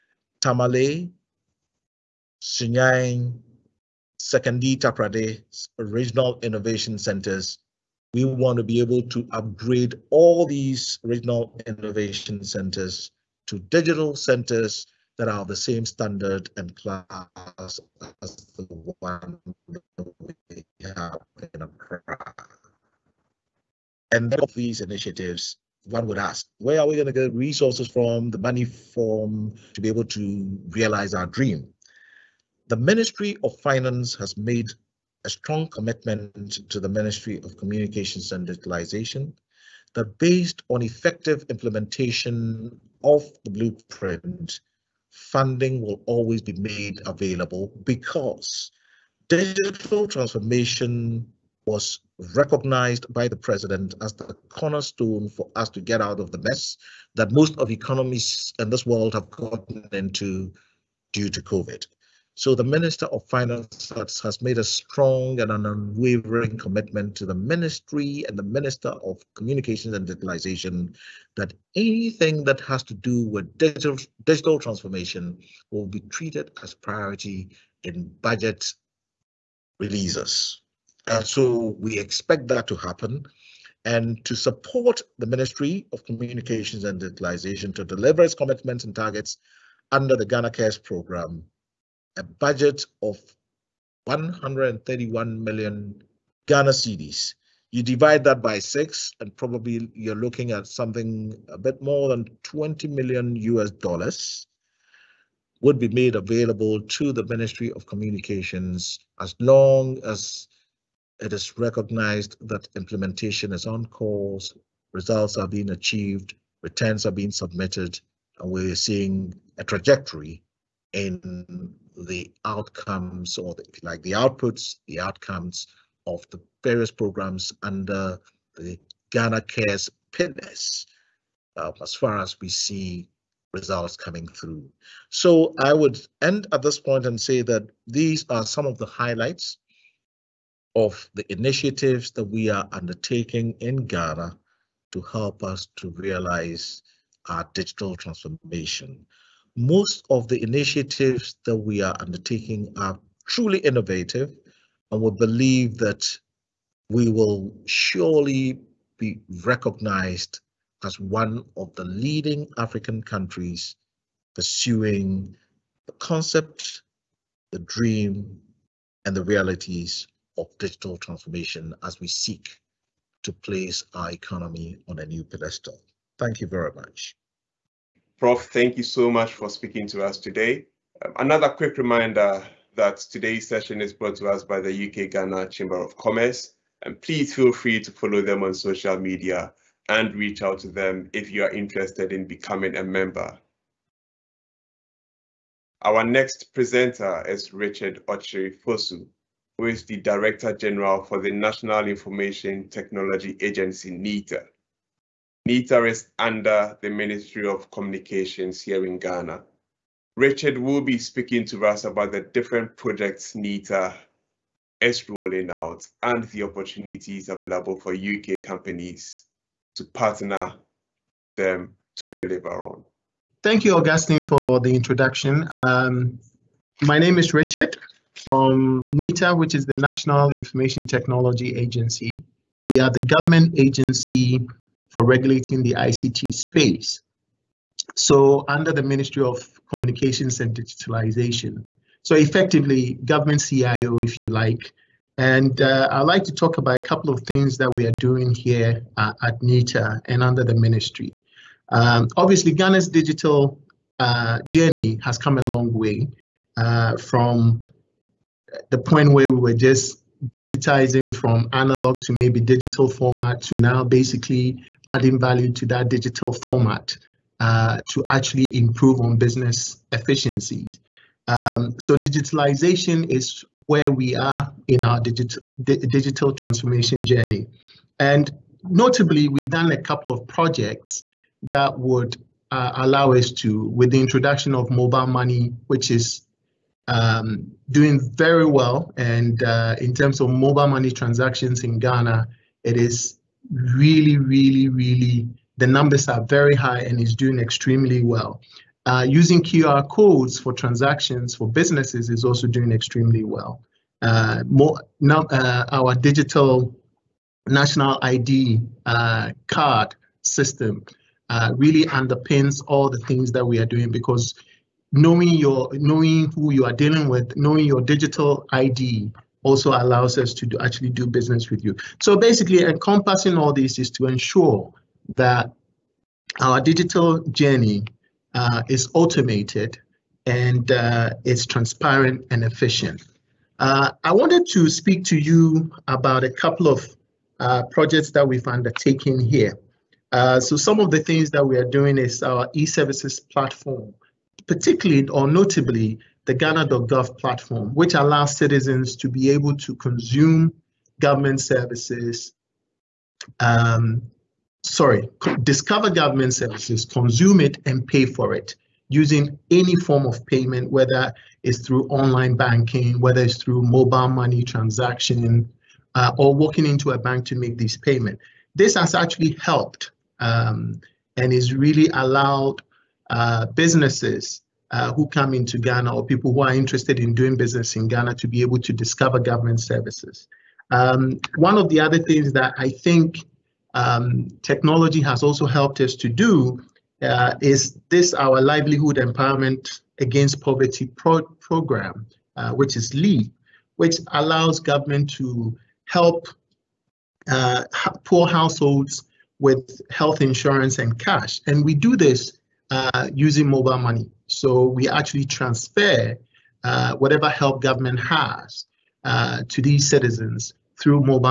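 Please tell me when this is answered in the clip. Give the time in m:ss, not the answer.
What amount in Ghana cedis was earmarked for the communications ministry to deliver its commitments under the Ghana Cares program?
1:34.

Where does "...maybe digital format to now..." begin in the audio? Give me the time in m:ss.
4:22.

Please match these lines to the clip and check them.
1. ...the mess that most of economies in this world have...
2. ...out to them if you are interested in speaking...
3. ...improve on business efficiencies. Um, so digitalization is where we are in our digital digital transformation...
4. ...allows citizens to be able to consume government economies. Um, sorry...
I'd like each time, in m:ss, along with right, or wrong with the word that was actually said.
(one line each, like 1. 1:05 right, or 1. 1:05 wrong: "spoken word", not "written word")
1. 0:56 right
2. 3:10 wrong: "becoming", not "speaking"
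3. 4:28 right
4. 5:47 wrong: "services", not "economies".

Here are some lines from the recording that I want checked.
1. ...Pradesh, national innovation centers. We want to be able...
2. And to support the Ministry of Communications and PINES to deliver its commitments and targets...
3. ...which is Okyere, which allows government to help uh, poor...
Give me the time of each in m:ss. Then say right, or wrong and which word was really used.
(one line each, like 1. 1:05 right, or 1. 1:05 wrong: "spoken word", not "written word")
1. 0:04 wrong: "regional", not "national"
2. 1:23 wrong: "Digitalization", not "PINES"
3. 6:32 wrong: "LEAP", not "Okyere".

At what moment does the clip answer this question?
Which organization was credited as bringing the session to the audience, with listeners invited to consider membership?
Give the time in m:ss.
3:04.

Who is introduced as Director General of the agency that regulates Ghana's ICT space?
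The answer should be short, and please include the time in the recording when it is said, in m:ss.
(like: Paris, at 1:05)
Richard Okyere Fosu, at 3:17.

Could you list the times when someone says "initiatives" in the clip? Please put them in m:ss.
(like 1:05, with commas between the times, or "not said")
0:24, 2:21, 2:30.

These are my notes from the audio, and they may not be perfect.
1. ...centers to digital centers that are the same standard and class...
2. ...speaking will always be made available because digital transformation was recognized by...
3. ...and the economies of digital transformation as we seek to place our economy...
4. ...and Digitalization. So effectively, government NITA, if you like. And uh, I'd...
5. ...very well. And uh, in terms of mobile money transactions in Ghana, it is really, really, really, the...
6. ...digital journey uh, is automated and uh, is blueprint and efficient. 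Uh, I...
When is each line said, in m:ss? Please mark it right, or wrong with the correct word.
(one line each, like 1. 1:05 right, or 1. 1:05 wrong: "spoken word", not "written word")
1. 0:12 right
2. 0:45 wrong: "funding", not "speaking"
3. 2:49 wrong: "realities", not "economies"
4. 4:00 wrong: "CIO", not "NITA"
5. 4:48 right
6. 5:26 wrong: "transparent", not "blueprint".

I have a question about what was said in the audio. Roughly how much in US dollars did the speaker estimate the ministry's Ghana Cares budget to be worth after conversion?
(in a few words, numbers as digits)
20 million US dollars.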